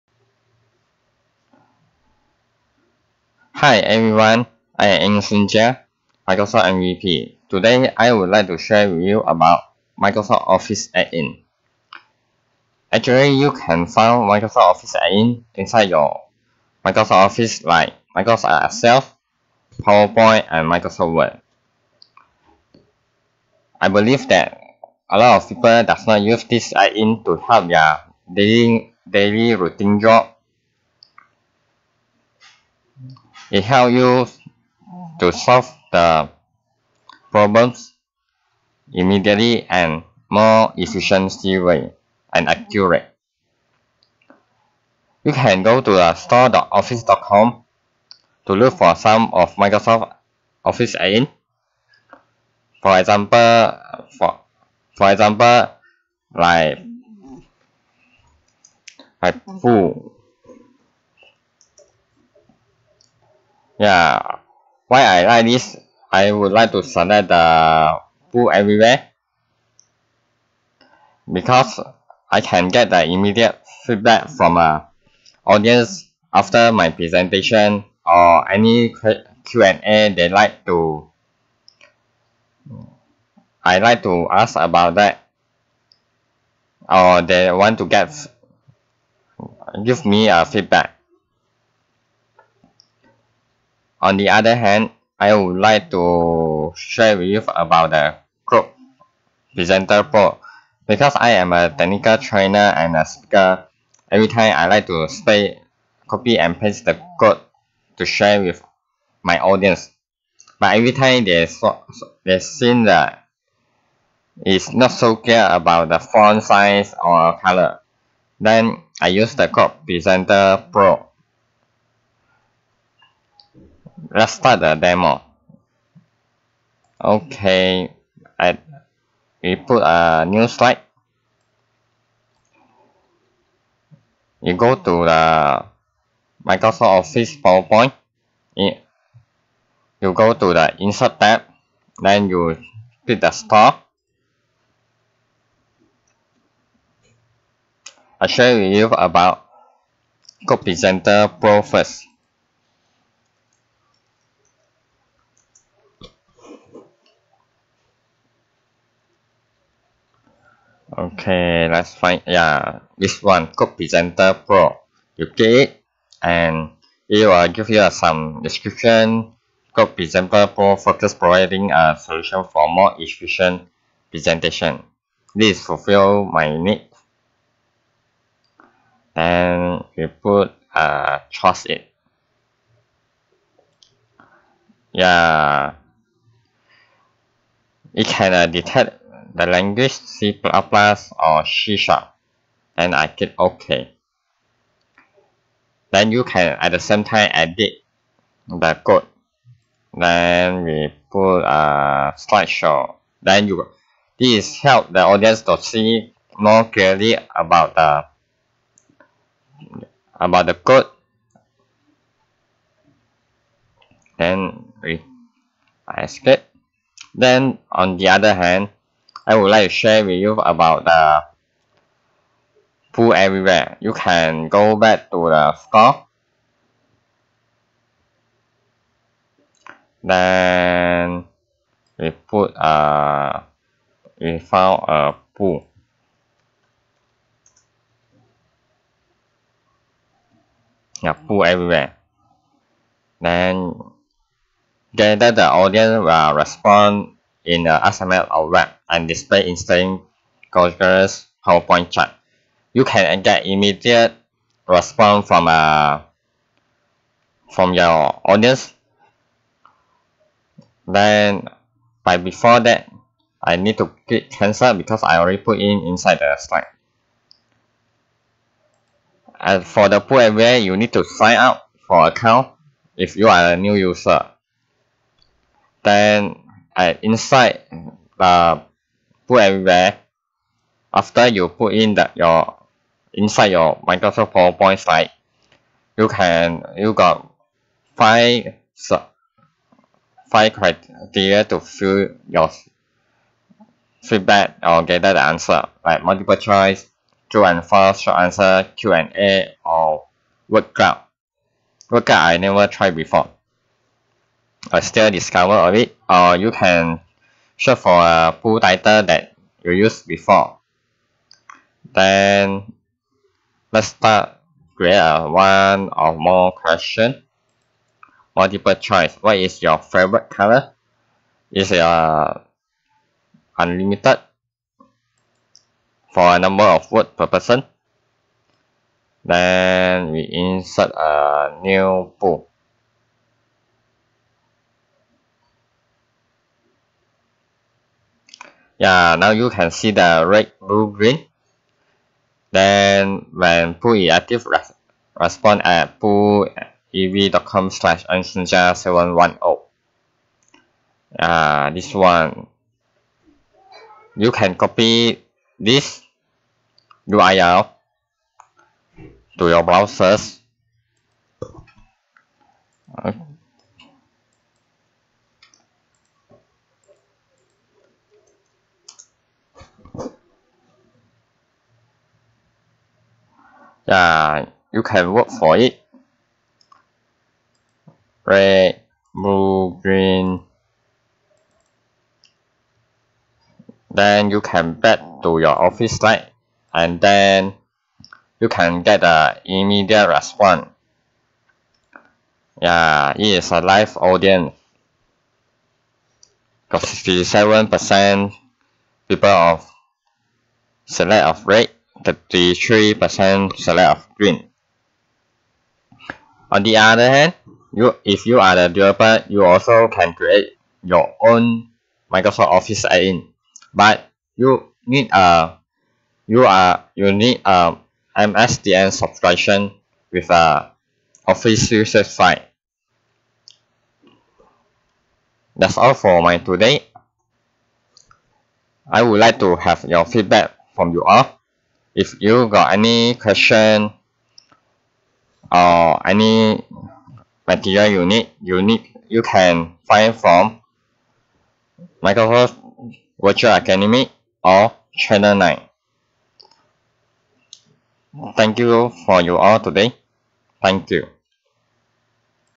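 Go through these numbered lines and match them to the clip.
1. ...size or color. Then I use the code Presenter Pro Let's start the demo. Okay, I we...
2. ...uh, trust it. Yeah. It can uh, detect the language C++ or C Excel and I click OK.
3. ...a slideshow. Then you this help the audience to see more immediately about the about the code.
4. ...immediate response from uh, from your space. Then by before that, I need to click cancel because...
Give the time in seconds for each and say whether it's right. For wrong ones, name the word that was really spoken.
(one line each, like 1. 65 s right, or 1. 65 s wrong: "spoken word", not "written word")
1. 116 s right
2. 180 s wrong: "Sharp", not "Excel"
3. 201 s wrong: "clearly", not "immediately"
4. 253 s wrong: "audience", not "space".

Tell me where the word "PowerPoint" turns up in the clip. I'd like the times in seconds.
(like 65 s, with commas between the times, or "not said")
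19 s, 137 s, 251 s, 284 s.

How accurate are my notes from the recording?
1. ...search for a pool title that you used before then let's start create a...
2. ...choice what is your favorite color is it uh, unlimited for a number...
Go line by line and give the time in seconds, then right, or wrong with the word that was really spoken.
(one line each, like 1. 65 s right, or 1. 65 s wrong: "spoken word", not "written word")
1. 307 s right
2. 318 s right.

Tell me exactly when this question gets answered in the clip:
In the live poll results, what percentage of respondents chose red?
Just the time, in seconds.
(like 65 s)
396 s.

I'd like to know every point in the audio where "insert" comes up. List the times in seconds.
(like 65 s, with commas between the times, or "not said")
140 s, 330 s.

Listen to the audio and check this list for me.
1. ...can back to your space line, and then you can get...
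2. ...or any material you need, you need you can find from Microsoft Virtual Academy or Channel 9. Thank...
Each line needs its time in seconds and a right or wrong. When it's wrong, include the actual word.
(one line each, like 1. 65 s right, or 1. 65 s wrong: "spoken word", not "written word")
1. 384 s wrong: "office", not "space"
2. 435 s right.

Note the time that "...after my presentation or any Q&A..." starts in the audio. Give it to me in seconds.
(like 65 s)
76 s.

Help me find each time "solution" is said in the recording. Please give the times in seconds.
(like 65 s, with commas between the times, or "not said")
171 s.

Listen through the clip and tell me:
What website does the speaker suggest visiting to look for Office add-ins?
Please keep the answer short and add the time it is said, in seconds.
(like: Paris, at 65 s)
store.office.com, at 46 s.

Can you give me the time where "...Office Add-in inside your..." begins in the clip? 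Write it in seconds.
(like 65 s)
14 s.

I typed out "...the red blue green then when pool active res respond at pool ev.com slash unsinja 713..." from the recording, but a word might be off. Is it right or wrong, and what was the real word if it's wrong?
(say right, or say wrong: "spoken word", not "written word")
wrong: "710", not "713".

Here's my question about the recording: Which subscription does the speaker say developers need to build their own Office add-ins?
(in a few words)
MSDN subscription.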